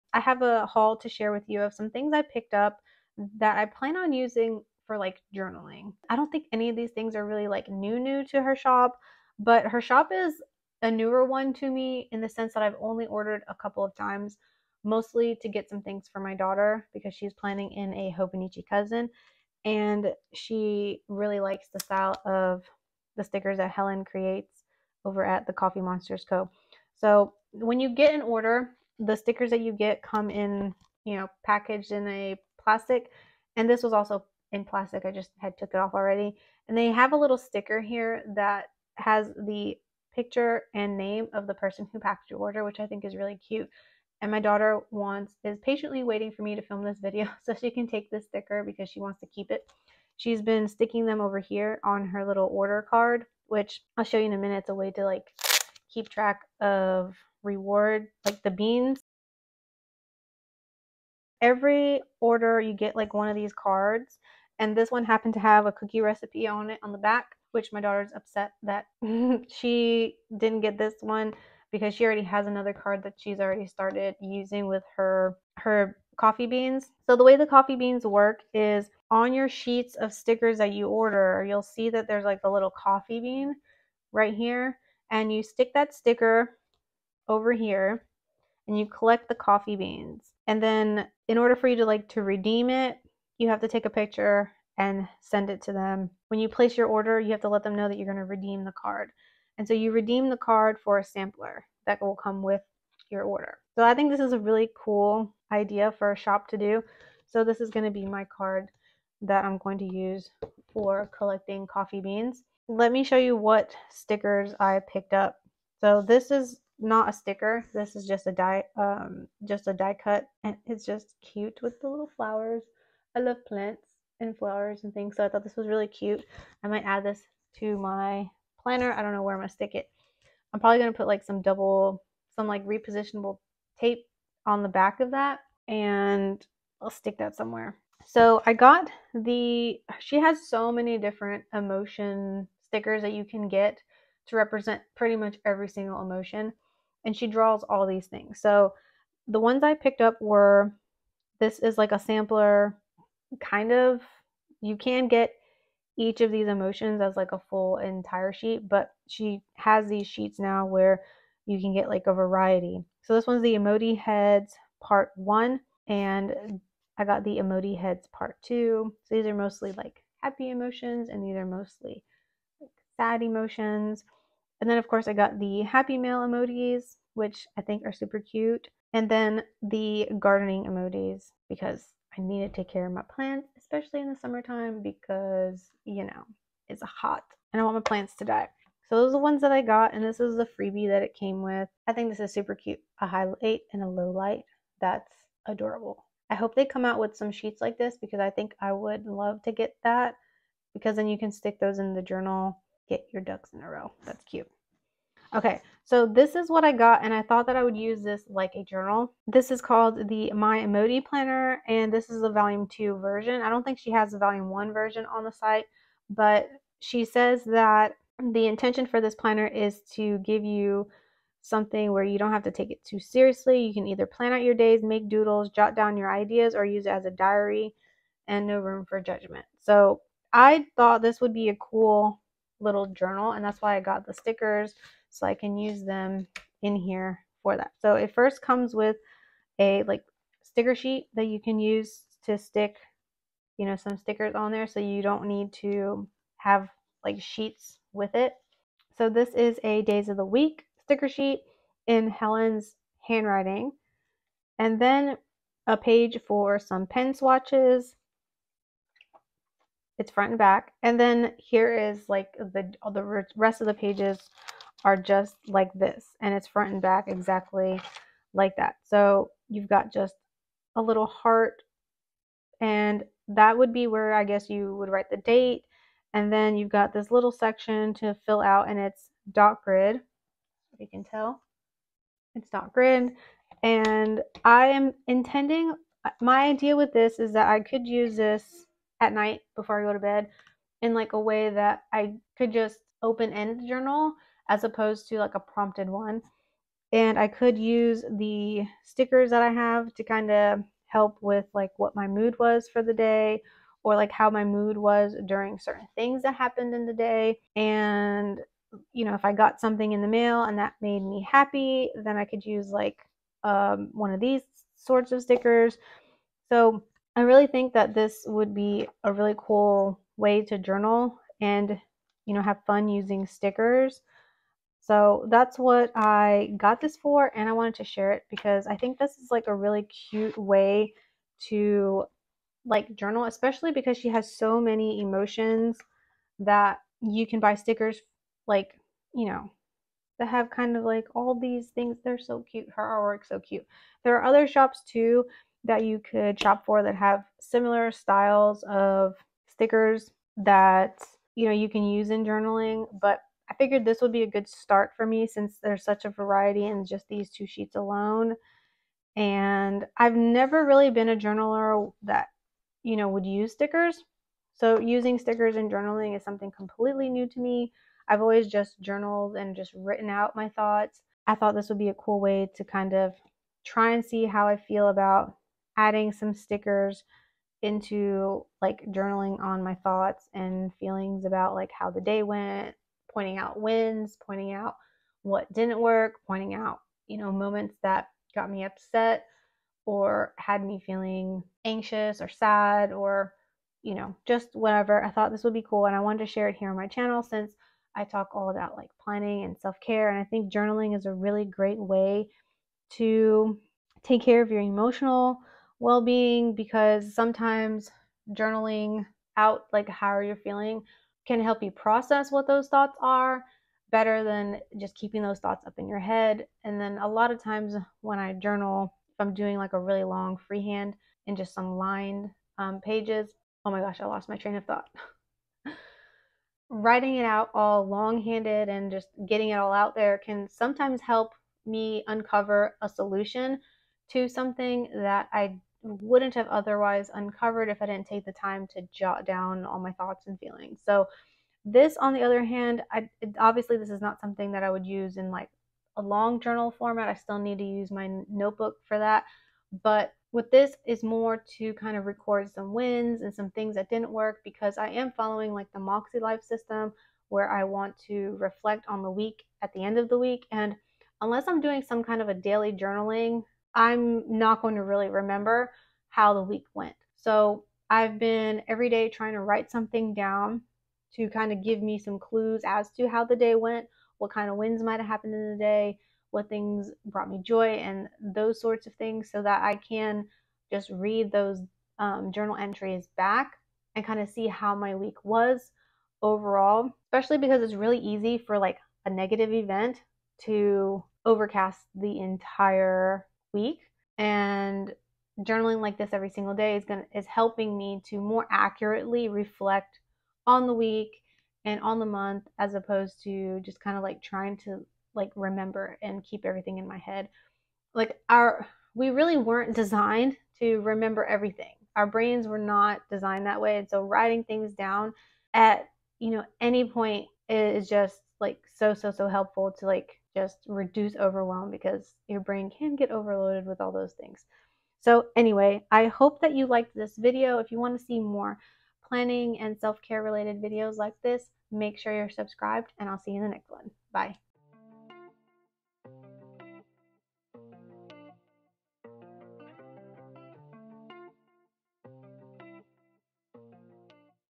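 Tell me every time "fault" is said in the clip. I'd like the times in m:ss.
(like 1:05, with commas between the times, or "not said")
not said.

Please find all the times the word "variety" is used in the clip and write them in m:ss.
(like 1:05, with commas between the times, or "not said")
2:42, 5:56.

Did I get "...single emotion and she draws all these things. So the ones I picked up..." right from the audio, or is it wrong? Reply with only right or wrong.
right.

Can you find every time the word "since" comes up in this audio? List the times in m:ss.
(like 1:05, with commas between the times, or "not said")
5:55, 6:37.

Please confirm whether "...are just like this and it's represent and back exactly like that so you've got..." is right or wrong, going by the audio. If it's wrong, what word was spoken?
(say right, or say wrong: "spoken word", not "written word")
wrong: "front", not "represent".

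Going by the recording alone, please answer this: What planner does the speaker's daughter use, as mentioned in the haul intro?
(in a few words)
Hobonichi cousin.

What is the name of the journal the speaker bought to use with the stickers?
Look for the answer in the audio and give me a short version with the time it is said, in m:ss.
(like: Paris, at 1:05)
My Emoji Planner, at 3:30.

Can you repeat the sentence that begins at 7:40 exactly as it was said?
And unless I'm doing some kind of a daily journaling I'm not going to really remember how the week went.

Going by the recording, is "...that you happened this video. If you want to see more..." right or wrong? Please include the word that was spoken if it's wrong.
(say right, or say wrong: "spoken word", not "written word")
wrong: "liked", not "happened".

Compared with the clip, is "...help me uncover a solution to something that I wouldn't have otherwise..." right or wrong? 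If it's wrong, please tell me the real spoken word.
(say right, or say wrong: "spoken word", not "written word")
right.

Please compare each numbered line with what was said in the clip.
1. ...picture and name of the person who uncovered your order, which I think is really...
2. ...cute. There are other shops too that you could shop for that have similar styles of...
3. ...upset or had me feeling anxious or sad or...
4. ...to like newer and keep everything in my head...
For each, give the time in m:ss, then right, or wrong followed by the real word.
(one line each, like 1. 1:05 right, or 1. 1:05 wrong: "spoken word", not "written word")
1. 0:40 wrong: "packed", not "uncovered"
2. 5:43 right
3. 6:28 right
4. 8:24 wrong: "remember", not "newer".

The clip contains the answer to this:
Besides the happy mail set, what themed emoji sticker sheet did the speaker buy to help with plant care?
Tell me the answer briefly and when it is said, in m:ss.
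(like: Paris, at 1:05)
gardening emojis, at 3:00.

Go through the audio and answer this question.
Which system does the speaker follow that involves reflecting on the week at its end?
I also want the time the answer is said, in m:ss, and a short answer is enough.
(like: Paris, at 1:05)
Moxie Life, at 7:35.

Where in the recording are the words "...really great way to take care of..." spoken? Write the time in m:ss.
6:41.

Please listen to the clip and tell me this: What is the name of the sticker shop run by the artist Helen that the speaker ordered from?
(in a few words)
Coffee Monsterz Co.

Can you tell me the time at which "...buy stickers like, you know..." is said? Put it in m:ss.
5:37.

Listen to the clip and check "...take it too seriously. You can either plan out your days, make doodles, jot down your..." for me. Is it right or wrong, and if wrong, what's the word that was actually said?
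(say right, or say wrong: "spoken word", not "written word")
right.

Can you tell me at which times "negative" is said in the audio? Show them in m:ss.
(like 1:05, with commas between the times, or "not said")
8:09.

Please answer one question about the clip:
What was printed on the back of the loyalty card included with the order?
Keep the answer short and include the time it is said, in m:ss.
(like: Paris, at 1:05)
a cookie recipe, at 1:05.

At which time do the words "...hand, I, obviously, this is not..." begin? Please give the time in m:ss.
7:22.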